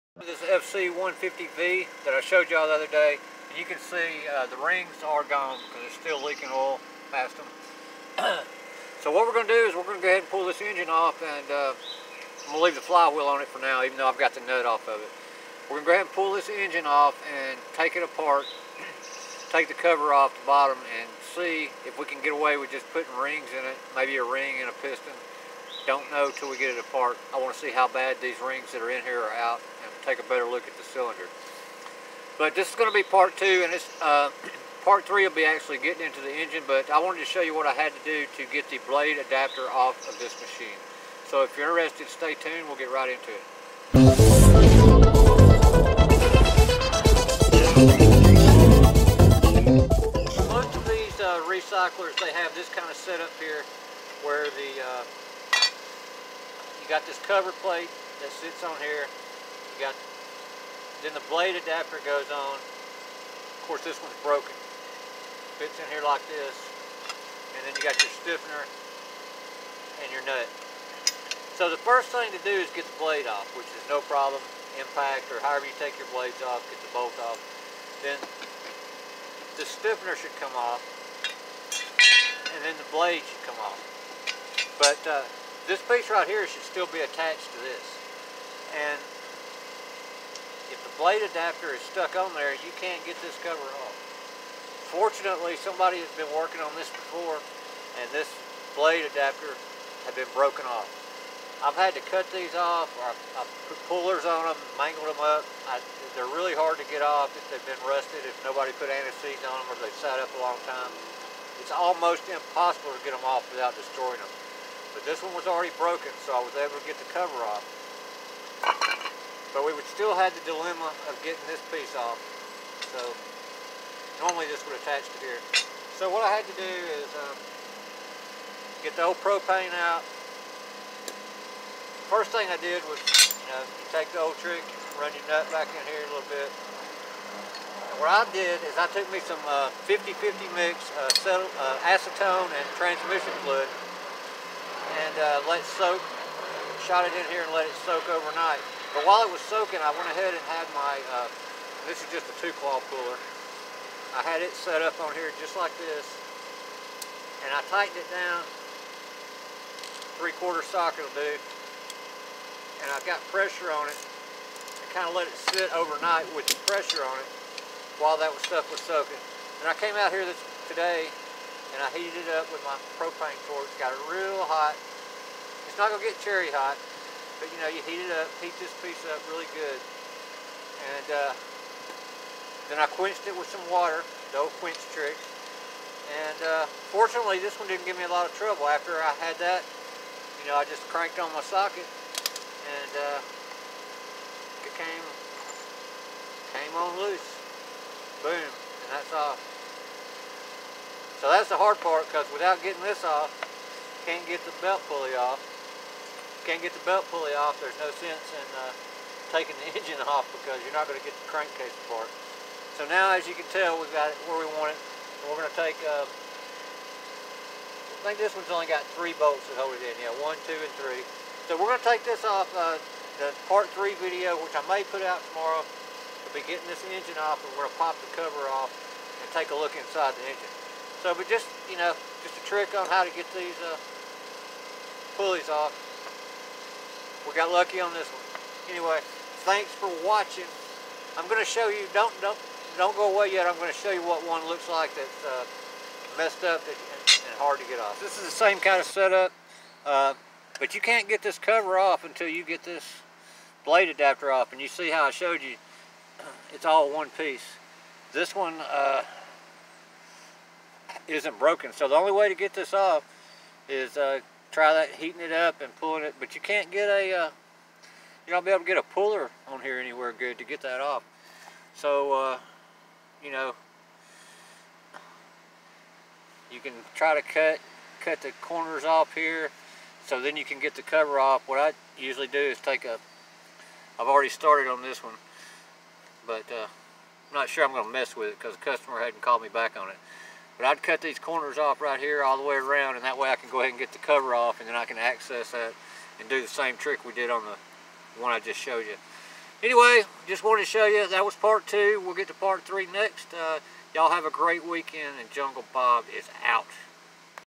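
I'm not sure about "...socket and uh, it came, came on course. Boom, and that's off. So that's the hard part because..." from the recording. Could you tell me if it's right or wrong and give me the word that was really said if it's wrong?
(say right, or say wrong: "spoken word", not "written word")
wrong: "loose", not "course".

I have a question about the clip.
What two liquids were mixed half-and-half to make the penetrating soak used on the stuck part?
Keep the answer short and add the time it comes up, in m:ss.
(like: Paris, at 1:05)
Acetone and transmission fluid, at 2:21.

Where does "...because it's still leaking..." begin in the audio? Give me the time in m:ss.
0:05.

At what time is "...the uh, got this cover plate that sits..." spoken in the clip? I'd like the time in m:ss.
0:54.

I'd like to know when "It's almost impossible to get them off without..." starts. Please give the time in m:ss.
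1:51.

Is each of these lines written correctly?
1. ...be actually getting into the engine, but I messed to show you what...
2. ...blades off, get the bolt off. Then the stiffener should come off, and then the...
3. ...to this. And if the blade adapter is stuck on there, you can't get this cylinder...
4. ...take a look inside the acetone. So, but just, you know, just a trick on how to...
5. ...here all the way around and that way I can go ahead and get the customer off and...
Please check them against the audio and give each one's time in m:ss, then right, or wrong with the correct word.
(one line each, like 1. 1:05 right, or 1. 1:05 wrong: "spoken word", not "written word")
1. 0:35 wrong: "wanted", not "messed"
2. 1:16 right
3. 1:27 wrong: "cover", not "cylinder"
4. 3:49 wrong: "engine", not "acetone"
5. 4:51 wrong: "cover", not "customer".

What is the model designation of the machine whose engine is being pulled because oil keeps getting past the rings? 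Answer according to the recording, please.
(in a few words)
FC150V.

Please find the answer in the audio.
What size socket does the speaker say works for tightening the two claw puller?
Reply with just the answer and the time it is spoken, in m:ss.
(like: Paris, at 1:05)
Three quarter, at 2:40.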